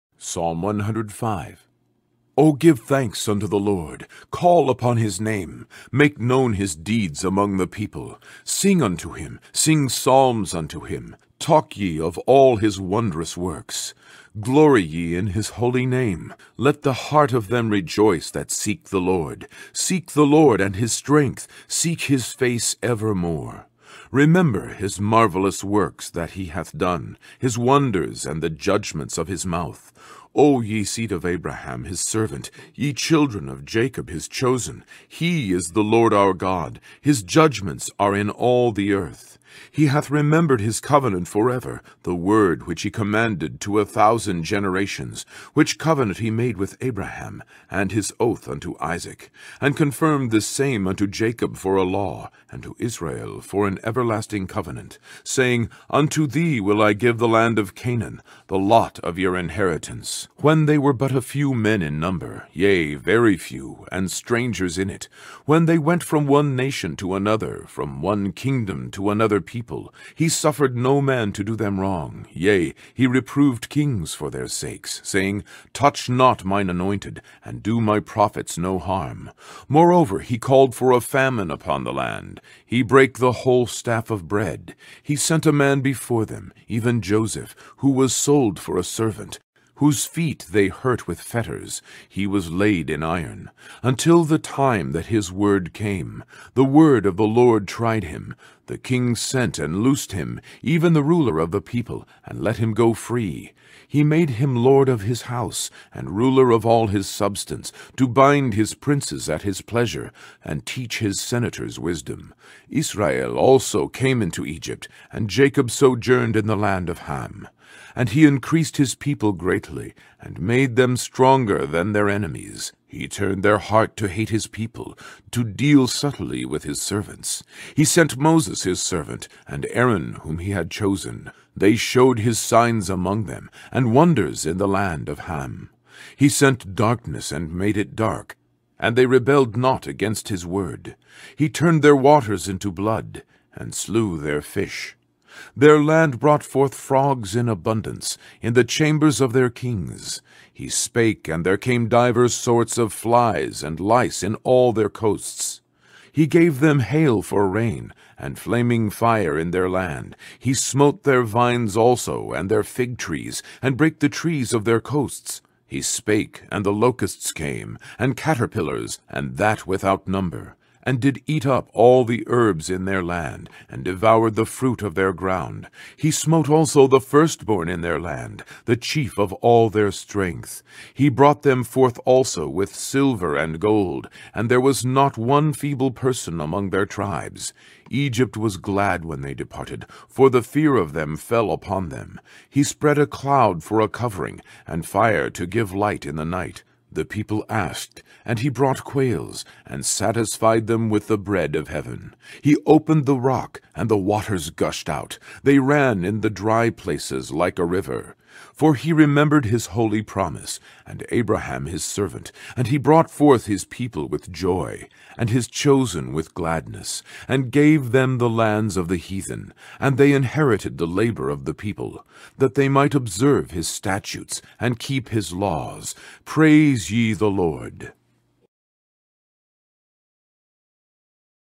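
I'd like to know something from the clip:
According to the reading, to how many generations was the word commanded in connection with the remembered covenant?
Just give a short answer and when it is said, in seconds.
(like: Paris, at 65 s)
1000, at 43 s.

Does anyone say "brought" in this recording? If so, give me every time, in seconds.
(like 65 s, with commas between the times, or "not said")
146 s, 181 s, 198 s, 212 s.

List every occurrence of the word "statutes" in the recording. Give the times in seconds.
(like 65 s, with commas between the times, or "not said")
223 s.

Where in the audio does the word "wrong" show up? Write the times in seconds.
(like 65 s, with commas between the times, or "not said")
71 s.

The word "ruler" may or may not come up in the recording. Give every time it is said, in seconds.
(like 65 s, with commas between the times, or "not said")
101 s, 106 s.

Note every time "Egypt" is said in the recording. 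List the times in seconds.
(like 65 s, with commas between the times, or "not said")
114 s, 187 s.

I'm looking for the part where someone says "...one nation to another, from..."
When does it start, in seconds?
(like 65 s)
66 s.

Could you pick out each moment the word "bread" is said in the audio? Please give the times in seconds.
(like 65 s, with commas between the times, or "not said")
84 s, 201 s.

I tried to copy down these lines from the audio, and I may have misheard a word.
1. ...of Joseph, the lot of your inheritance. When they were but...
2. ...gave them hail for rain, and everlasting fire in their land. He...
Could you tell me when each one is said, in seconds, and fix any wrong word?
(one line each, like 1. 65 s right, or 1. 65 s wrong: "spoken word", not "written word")
1. 57 s wrong: "Canaan", not "Joseph"
2. 156 s wrong: "flaming", not "everlasting".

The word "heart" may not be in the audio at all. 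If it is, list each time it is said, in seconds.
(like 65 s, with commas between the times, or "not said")
17 s, 123 s.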